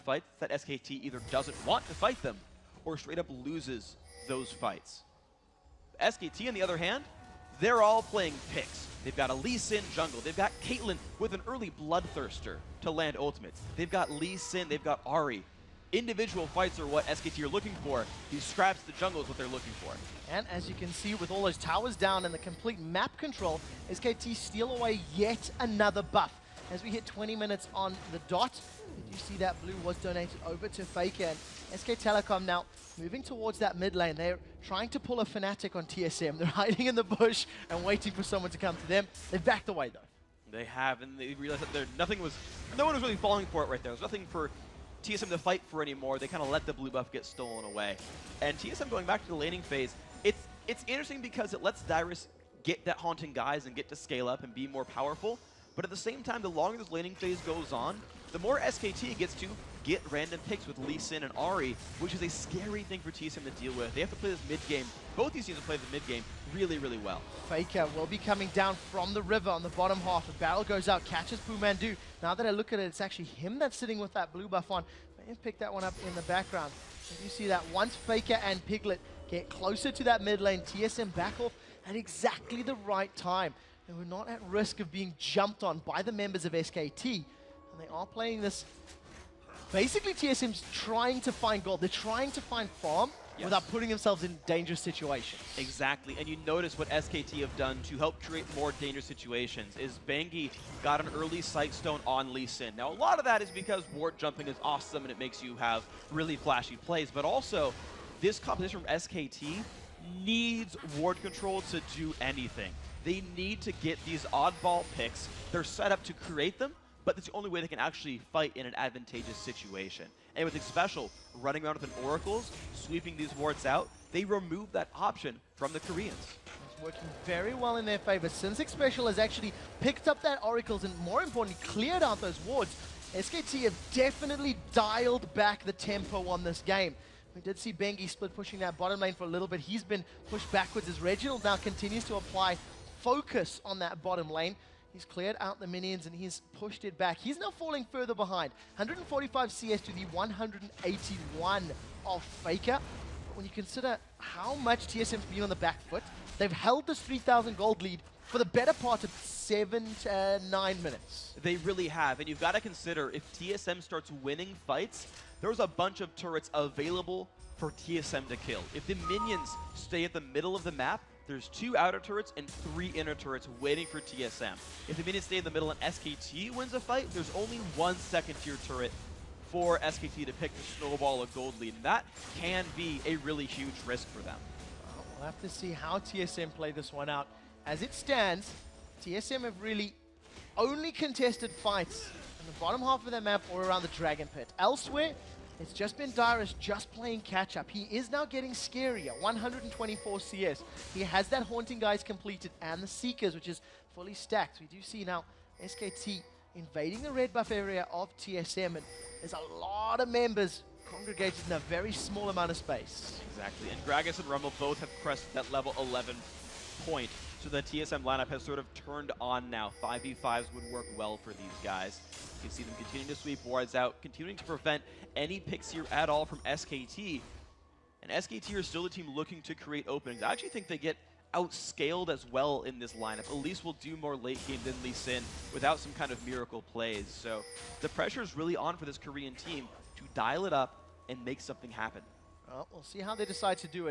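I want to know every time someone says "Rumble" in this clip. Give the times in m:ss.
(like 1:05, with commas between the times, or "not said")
3:34.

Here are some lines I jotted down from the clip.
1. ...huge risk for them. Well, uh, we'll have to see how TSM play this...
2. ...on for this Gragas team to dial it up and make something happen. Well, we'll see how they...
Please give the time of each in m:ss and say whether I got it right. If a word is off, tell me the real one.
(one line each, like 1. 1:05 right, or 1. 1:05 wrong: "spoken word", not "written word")
1. 3:03 right
2. 3:58 wrong: "Korean", not "Gragas".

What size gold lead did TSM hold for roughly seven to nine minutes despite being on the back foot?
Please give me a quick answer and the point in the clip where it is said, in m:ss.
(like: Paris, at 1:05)
3,000 gold, at 2:36.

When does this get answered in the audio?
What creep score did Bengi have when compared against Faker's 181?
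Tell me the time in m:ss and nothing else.
2:28.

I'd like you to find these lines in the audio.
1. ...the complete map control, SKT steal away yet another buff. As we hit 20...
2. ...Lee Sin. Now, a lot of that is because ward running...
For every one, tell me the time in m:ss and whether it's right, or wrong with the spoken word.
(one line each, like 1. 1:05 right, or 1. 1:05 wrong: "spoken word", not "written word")
1. 0:22 right
2. 1:42 wrong: "jumping", not "running".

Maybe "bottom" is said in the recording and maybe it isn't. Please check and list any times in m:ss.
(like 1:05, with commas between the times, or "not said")
1:09, 2:18, 2:24, 3:12.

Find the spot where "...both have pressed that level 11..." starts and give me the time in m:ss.
3:34.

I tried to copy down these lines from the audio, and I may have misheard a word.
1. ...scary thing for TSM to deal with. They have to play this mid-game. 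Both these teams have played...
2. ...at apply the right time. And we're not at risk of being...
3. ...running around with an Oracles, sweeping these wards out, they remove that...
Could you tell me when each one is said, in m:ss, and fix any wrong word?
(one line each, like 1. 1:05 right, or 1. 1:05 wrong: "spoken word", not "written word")
1. 1:02 right
2. 1:21 wrong: "exactly", not "apply"
3. 2:01 right.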